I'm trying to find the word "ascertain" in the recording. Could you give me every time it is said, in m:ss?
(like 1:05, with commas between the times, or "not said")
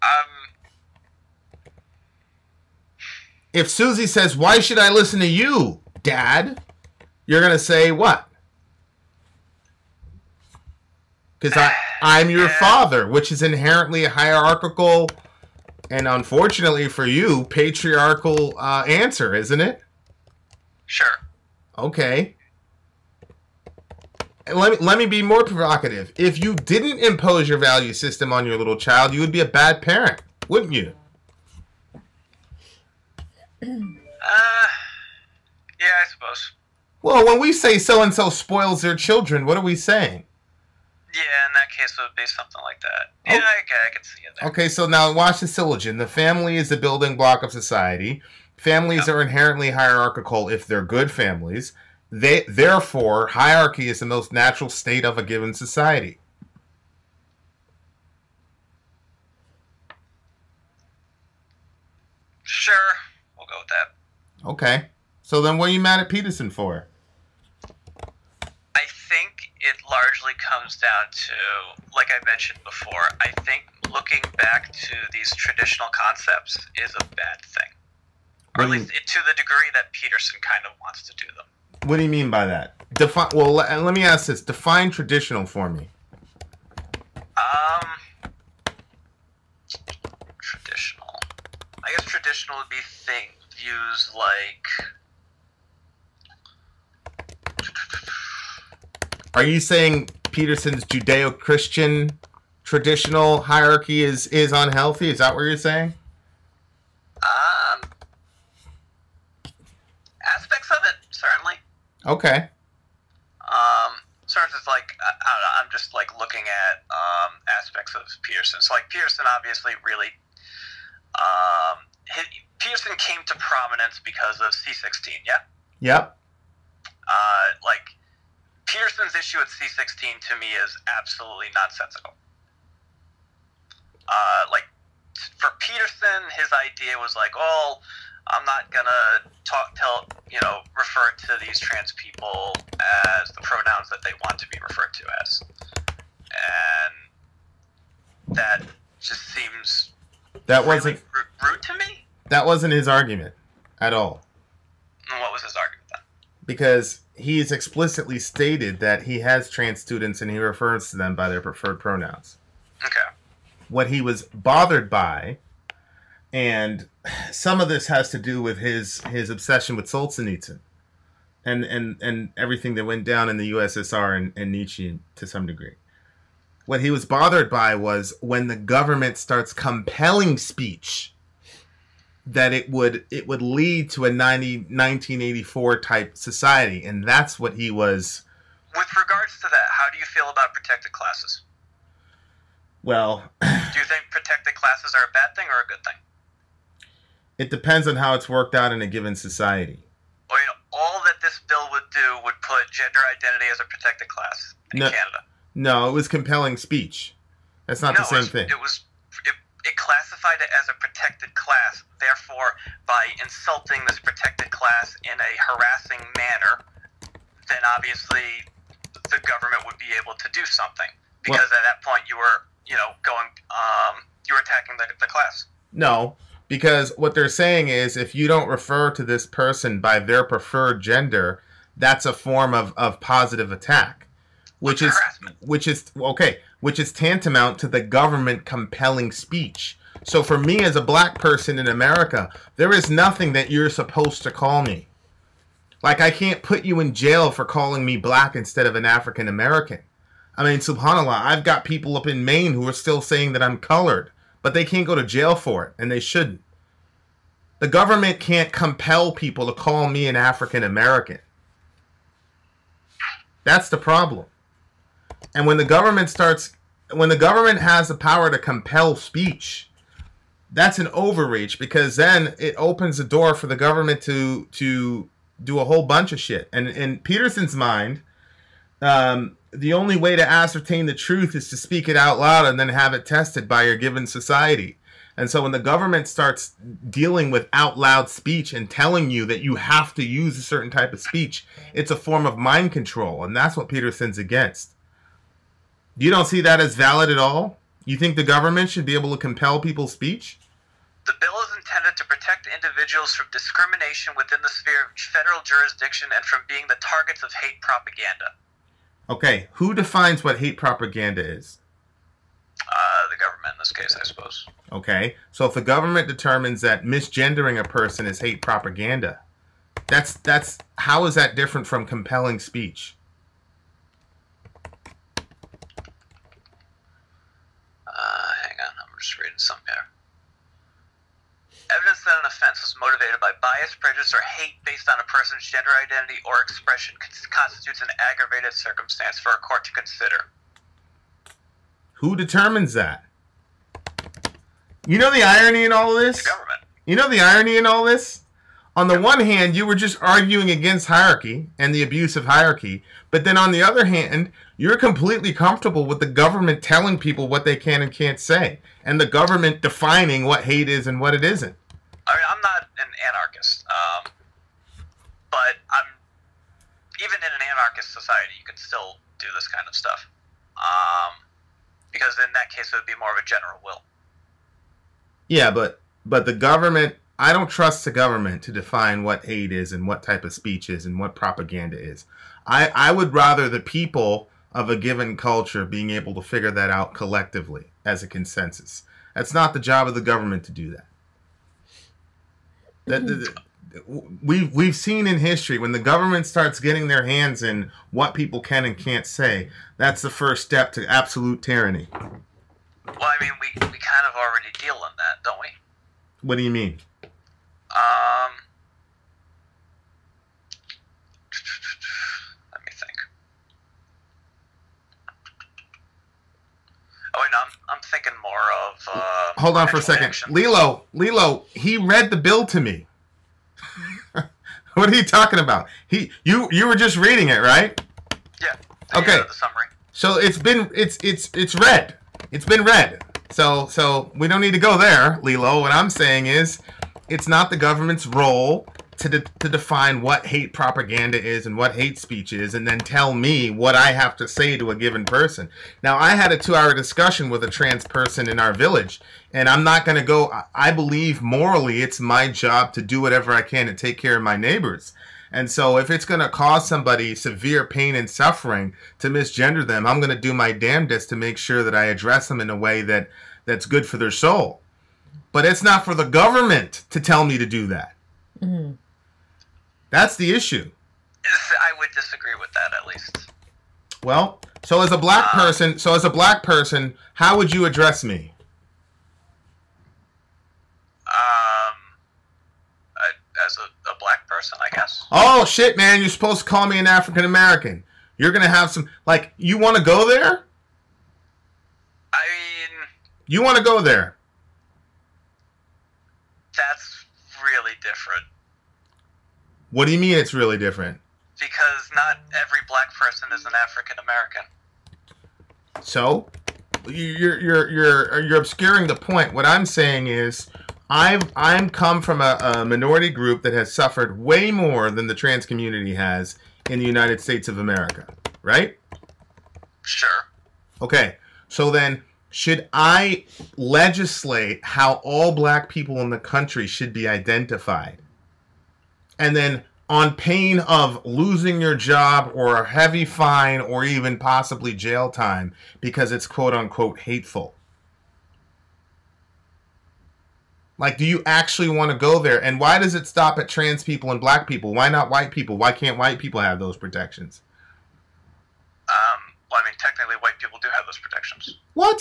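4:40.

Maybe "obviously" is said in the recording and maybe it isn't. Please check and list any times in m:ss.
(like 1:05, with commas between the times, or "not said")
1:59, 3:37.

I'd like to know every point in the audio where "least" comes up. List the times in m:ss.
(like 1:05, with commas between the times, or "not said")
1:18, 7:52.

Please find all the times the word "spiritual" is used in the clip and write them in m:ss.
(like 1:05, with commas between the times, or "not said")
not said.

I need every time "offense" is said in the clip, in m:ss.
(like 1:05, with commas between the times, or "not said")
5:32.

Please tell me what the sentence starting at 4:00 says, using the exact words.
So for me as a black person in America, there is nothing that you're supposed to call me.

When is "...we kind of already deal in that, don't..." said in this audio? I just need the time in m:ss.
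6:43.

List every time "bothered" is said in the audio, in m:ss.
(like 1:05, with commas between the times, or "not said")
2:44, 2:57.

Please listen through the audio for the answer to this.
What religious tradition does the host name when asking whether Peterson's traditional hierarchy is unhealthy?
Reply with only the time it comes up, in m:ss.
1:40.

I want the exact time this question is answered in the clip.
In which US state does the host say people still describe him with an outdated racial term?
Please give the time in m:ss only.
4:12.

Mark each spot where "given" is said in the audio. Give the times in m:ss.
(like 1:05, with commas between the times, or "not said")
0:55, 3:18, 4:43, 6:24, 7:24.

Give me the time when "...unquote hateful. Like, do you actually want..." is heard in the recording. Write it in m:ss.
8:56.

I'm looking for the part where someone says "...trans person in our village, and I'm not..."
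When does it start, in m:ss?
7:27.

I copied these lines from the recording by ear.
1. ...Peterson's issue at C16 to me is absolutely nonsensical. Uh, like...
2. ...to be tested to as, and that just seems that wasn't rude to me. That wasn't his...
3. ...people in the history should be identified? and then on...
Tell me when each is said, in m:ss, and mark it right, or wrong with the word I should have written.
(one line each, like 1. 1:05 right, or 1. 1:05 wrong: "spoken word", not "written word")
1. 2:08 right
2. 2:24 wrong: "referred", not "tested"
3. 8:45 wrong: "country", not "history".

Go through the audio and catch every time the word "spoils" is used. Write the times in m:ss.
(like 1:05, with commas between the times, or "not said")
0:38.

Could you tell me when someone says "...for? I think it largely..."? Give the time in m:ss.
1:06.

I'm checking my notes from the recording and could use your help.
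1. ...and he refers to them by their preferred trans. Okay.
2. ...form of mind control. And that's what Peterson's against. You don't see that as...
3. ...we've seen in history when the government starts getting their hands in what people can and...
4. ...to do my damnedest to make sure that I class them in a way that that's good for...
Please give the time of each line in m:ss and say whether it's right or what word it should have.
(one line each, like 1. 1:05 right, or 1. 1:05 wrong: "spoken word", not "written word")
1. 2:40 wrong: "pronouns", not "trans"
2. 4:51 right
3. 6:34 right
4. 7:40 wrong: "address", not "class".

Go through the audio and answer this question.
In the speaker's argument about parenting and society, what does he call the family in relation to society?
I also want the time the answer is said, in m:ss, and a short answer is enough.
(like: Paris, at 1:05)
The building block, at 0:46.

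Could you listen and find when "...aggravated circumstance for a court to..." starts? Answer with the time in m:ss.
5:38.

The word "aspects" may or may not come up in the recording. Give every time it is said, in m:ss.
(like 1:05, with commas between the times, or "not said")
1:50, 1:57.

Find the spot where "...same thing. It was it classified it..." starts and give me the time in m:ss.
3:28.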